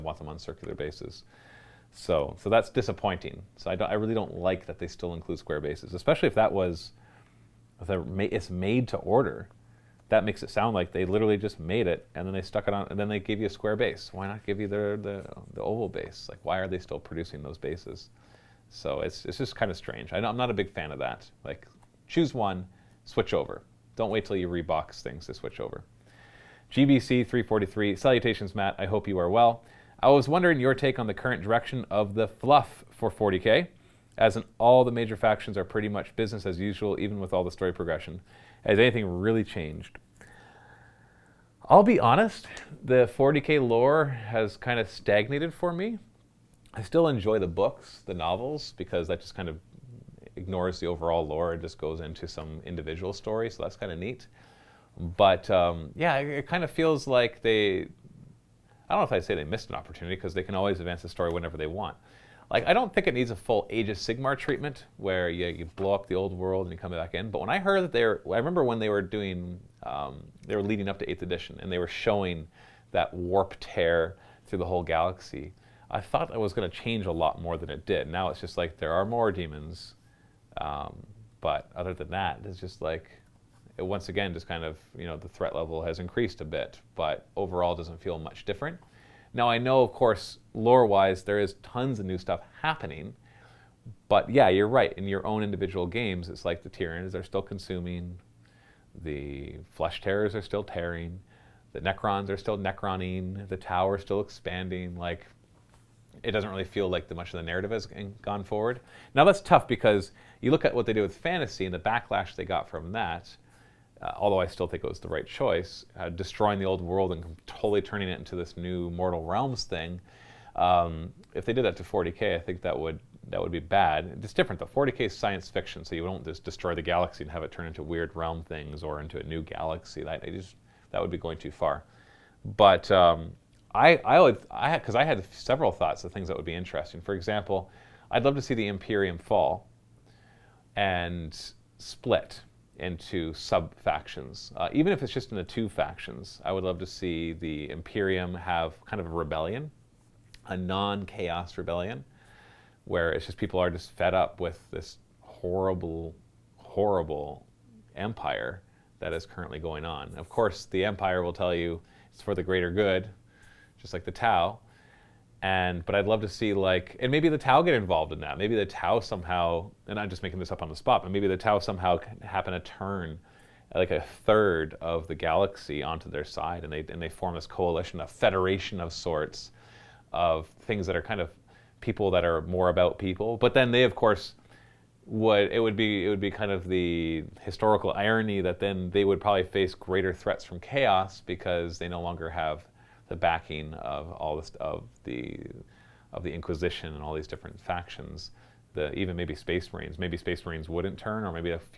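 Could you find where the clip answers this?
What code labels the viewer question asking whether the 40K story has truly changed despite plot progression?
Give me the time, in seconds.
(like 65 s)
26 s.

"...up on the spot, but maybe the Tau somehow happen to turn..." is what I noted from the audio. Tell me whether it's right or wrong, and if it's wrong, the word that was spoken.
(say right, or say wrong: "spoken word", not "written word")
right.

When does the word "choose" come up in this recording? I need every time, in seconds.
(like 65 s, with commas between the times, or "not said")
22 s.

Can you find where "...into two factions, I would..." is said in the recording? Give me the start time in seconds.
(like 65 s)
145 s.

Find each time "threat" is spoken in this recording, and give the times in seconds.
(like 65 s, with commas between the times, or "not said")
85 s, 190 s.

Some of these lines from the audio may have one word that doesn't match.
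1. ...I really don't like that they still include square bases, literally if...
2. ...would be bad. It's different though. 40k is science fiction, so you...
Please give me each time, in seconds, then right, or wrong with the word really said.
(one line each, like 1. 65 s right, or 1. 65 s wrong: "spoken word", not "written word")
1. 3 s wrong: "especially", not "literally"
2. 123 s right.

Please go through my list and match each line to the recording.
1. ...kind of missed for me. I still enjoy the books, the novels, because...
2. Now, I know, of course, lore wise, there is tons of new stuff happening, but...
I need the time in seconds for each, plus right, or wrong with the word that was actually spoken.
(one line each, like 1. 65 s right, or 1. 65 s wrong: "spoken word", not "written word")
1. 44 s wrong: "stagnated", not "missed"
2. 89 s right.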